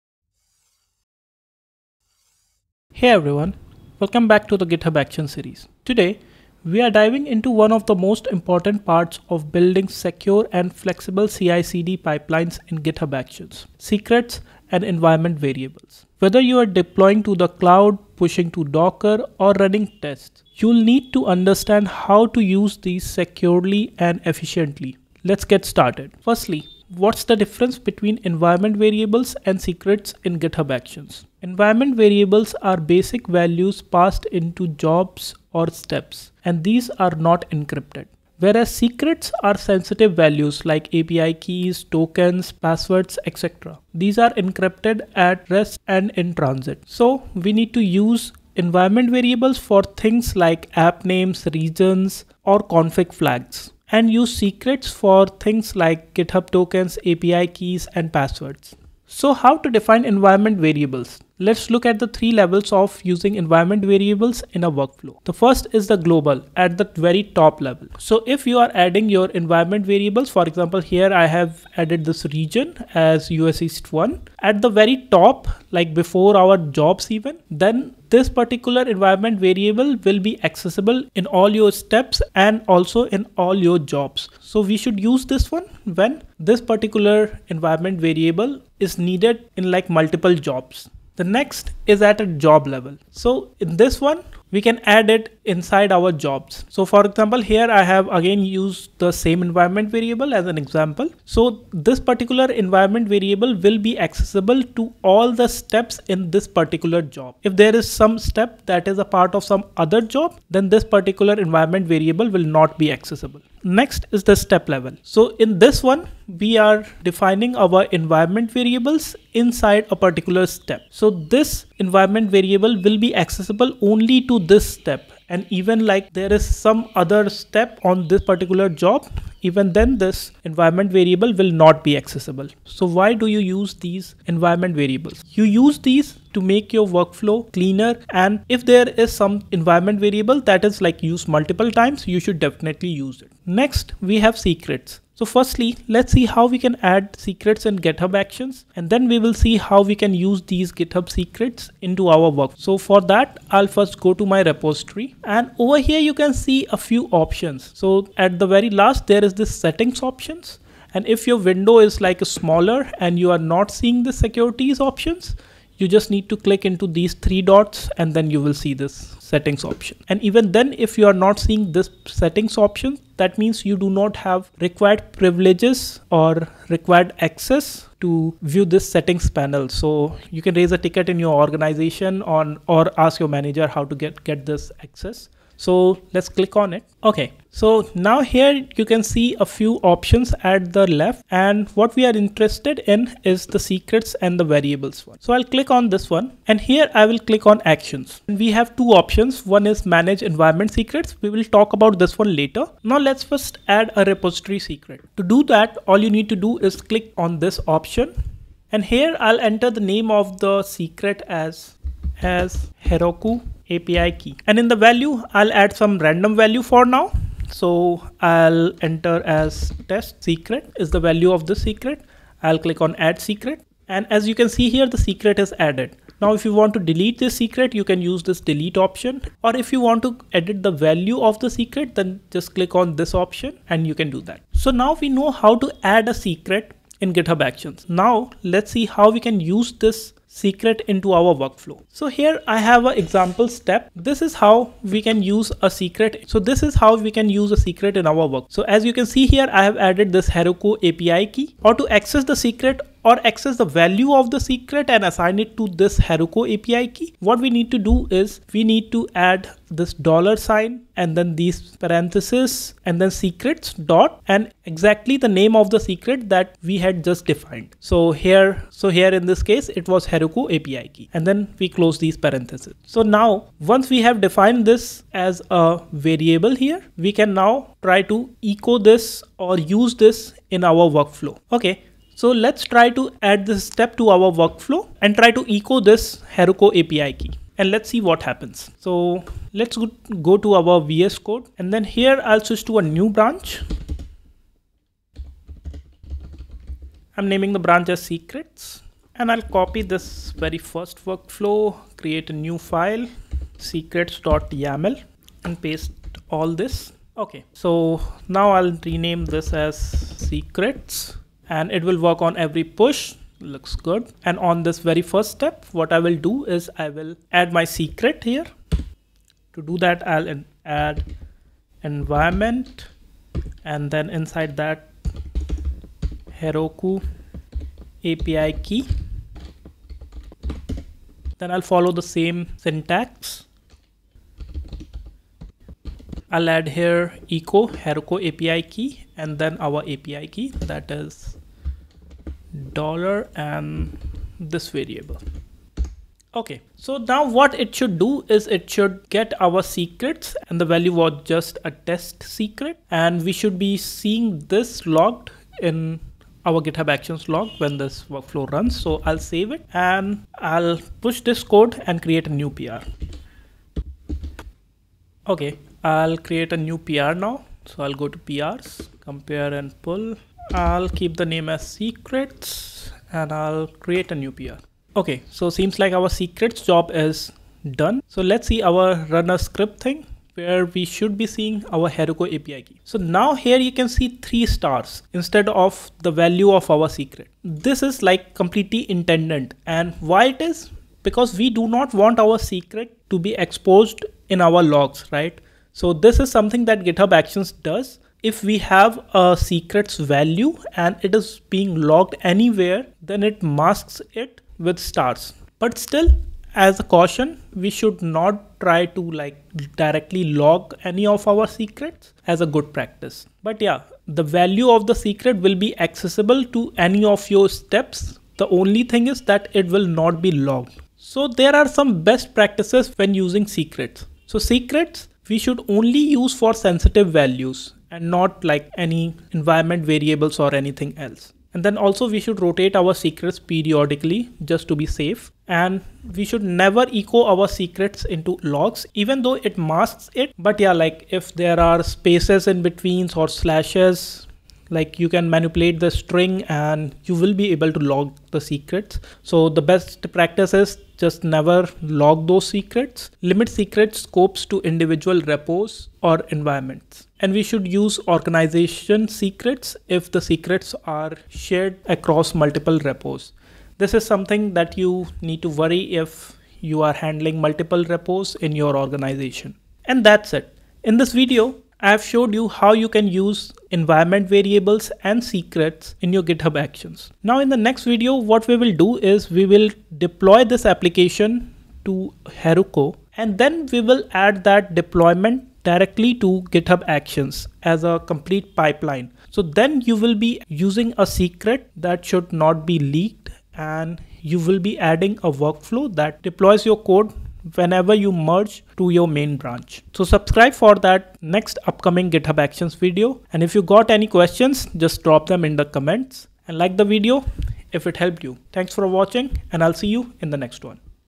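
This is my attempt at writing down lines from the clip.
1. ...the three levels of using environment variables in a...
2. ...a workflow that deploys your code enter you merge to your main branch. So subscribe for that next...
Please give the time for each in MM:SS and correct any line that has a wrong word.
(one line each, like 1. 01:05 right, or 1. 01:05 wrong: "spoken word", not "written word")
1. 01:01 right
2. 08:15 wrong: "whenever", not "enter".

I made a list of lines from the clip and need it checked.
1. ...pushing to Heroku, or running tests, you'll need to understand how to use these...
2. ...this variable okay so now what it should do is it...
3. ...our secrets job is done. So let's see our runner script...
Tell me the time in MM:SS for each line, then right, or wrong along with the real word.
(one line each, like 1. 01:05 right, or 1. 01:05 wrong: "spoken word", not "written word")
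1. 00:18 wrong: "Docker", not "Heroku"
2. 05:44 right
3. 06:15 right.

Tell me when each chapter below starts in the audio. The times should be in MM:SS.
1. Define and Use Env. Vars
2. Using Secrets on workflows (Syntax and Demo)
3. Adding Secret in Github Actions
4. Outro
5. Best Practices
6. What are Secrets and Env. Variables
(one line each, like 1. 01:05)
1. 00:58
2. 04:01
3. 02:23
4. 07:56
5. 06:59
6. 00:25.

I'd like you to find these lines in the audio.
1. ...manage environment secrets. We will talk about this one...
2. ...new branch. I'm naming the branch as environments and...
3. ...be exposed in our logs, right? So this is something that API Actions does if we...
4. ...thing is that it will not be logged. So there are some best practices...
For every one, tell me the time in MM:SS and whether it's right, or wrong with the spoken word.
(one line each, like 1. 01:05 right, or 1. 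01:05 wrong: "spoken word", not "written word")
1. 03:19 right
2. 04:52 wrong: "secrets", not "environments"
3. 06:33 wrong: "GitHub", not "API"
4. 06:58 right.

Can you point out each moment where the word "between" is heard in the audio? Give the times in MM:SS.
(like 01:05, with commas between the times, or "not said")
00:27, 07:22.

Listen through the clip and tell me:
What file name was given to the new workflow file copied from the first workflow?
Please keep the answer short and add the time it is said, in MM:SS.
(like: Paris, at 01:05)
secrets.yml, at 05:03.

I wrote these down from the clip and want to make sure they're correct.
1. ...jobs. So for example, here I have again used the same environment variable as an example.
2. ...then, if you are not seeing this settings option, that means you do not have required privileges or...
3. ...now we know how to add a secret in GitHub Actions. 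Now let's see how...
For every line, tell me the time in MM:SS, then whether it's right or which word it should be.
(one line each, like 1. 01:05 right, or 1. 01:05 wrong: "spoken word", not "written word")
1. 01:36 right
2. 02:50 right
3. 03:54 right.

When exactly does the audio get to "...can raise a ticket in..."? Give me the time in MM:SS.
03:00.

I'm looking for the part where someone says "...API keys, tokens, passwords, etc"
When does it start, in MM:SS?
00:40.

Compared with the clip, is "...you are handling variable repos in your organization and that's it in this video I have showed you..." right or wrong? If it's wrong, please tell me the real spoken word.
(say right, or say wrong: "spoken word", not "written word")
wrong: "multiple", not "variable".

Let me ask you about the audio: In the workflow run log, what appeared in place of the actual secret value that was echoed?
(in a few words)
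three stars.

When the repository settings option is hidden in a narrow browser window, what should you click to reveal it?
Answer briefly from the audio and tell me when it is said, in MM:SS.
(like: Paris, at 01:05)
three dots, at 02:47.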